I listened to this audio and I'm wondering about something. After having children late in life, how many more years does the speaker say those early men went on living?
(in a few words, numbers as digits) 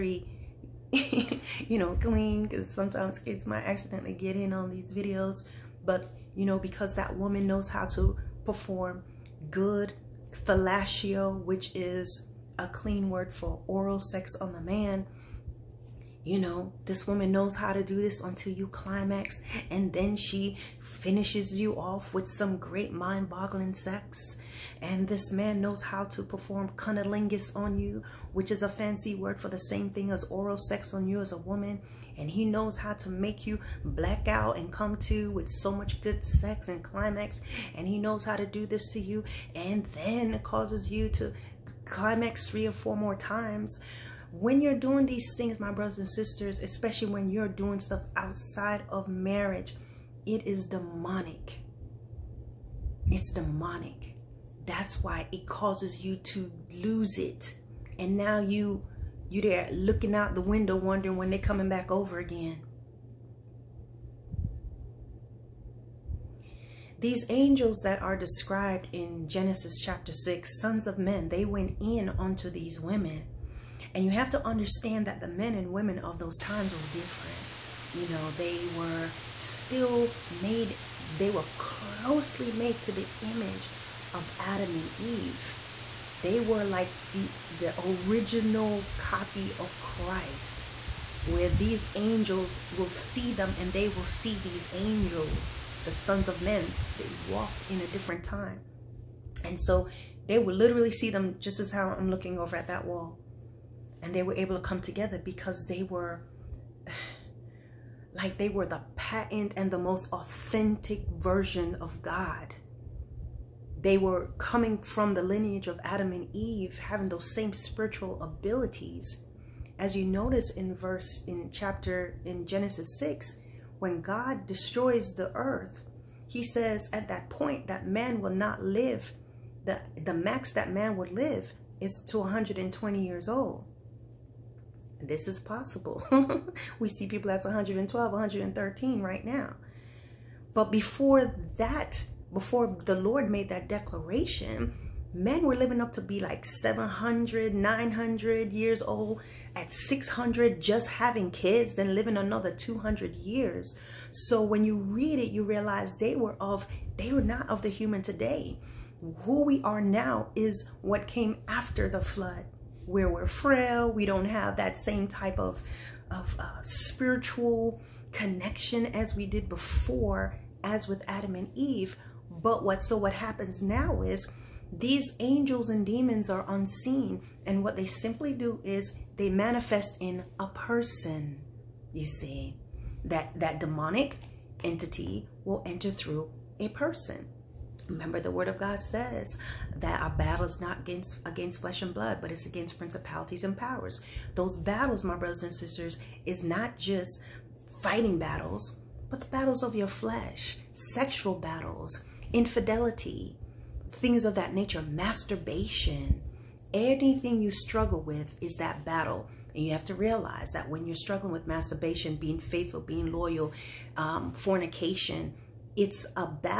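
200.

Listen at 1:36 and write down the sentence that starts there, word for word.
They walked in a different time.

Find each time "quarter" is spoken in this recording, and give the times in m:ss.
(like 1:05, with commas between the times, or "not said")
not said.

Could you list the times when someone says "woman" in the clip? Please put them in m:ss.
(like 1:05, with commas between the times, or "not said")
0:07, 0:17, 0:31.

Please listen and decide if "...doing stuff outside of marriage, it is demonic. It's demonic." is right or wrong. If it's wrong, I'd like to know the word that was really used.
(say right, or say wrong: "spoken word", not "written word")
right.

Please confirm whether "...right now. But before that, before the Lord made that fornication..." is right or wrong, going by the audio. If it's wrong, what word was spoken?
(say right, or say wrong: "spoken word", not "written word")
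wrong: "declaration", not "fornication".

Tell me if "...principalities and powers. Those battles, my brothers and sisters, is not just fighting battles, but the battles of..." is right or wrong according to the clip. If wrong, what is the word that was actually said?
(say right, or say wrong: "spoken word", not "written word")
right.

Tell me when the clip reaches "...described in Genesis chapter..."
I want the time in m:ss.
1:08.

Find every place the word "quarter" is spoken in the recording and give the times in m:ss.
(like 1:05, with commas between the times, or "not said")
not said.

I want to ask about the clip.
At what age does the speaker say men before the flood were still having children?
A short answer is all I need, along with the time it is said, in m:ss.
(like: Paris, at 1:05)
600, at 2:29.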